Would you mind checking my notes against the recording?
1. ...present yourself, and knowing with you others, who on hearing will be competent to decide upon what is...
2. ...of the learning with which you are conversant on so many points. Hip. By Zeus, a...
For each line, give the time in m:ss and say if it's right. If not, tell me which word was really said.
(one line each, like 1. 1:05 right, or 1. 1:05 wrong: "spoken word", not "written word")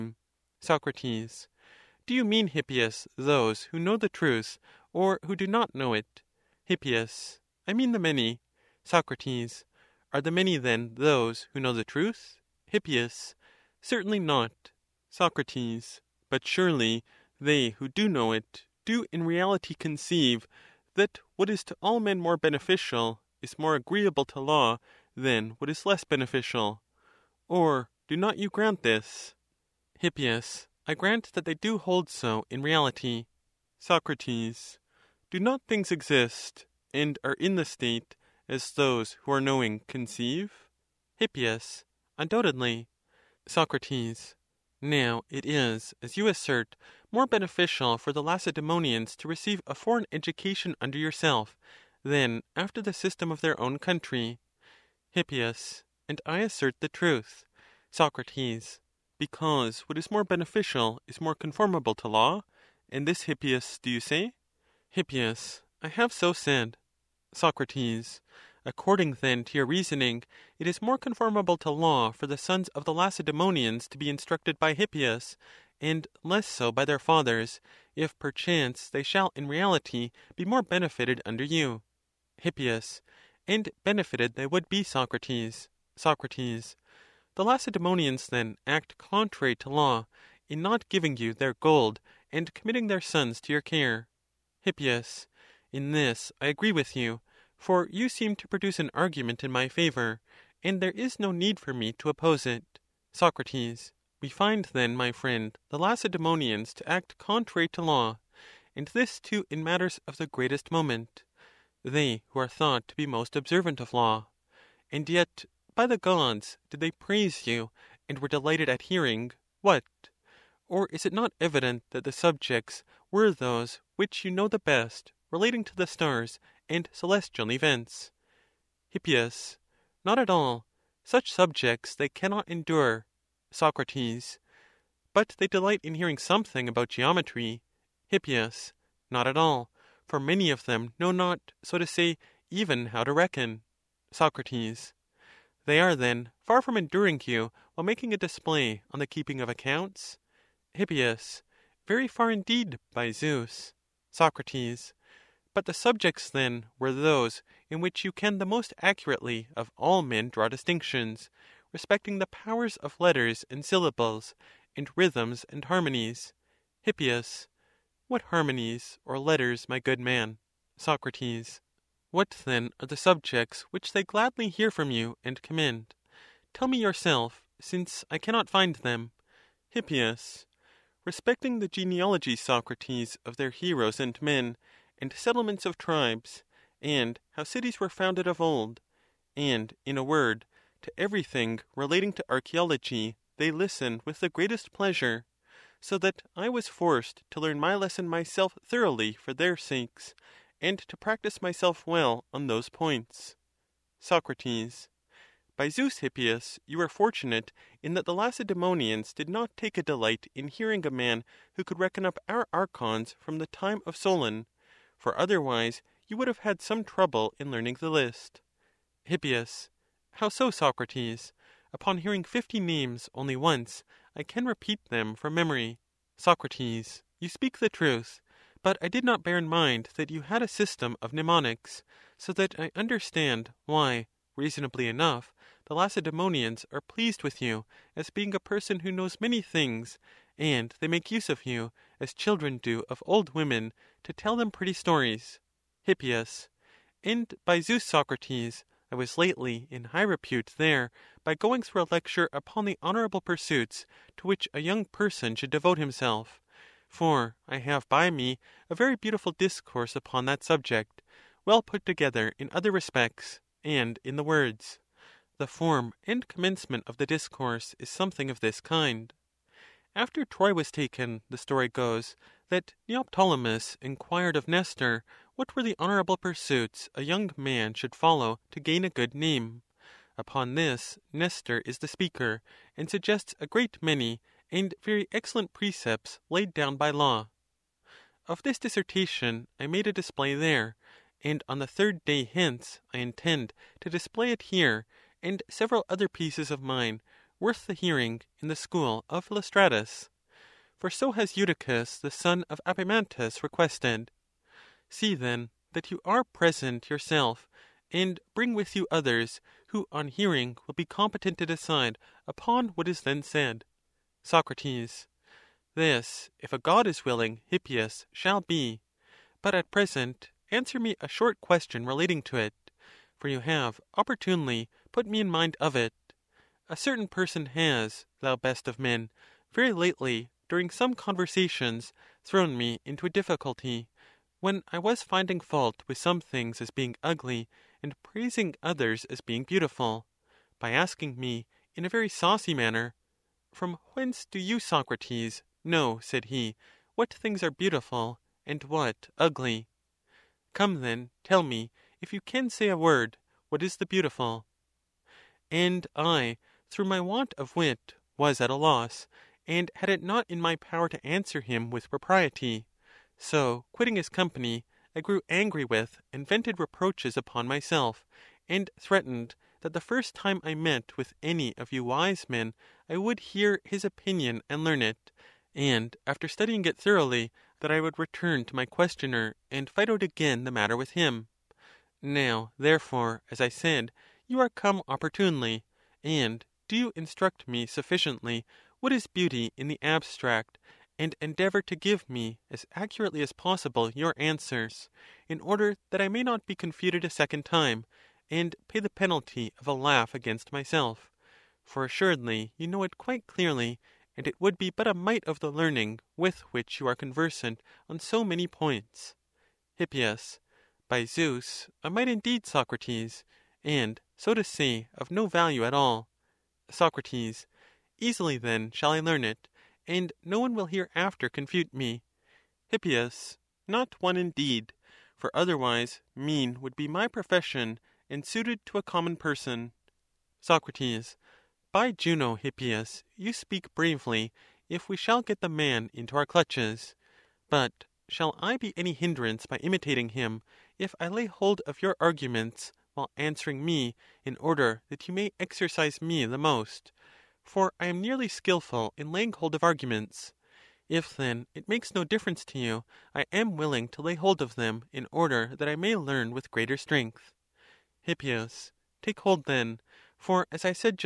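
1. 5:06 wrong: "bring", not "knowing"
2. 6:45 right.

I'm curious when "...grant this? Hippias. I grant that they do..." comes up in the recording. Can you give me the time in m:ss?
0:28.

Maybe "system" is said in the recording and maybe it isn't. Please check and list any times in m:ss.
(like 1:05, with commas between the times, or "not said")
0:52, 3:50.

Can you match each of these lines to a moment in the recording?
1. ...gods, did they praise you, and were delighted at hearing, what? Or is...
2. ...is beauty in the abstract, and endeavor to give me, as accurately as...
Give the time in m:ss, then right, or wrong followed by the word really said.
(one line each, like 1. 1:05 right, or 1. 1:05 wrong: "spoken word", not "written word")
1. 1:55 right
2. 6:28 right.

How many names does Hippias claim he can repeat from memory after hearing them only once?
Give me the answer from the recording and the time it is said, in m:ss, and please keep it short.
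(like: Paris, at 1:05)
50, at 3:42.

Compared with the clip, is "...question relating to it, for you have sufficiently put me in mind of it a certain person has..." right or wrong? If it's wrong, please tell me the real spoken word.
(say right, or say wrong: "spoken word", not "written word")
wrong: "opportunely", not "sufficiently".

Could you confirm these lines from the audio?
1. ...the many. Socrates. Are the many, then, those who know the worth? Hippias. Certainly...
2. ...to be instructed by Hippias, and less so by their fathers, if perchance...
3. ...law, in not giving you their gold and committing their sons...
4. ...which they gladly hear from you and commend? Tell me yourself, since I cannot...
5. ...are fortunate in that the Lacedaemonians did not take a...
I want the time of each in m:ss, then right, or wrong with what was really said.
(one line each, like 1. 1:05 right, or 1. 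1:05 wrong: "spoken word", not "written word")
1. 0:07 wrong: "truth", not "worth"
2. 1:13 right
3. 1:29 right
4. 2:53 right
5. 3:26 right.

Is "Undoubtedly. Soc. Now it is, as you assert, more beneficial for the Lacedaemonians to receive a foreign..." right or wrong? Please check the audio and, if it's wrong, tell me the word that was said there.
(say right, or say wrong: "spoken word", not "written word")
right.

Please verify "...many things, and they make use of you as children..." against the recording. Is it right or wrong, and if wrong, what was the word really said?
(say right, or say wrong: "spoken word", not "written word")
right.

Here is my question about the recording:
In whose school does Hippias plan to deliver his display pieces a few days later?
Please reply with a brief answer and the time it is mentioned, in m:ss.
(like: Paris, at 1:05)
Phidostratus, at 4:59.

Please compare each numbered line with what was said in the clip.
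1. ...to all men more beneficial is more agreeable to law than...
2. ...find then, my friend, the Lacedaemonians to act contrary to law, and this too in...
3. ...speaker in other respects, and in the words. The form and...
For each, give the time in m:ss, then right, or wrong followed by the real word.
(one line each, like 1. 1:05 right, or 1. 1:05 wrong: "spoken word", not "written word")
1. 0:21 right
2. 1:44 right
3. 4:21 wrong: "together", not "speaker".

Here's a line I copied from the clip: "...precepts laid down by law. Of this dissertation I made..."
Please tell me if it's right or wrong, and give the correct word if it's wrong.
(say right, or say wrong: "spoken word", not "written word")
right.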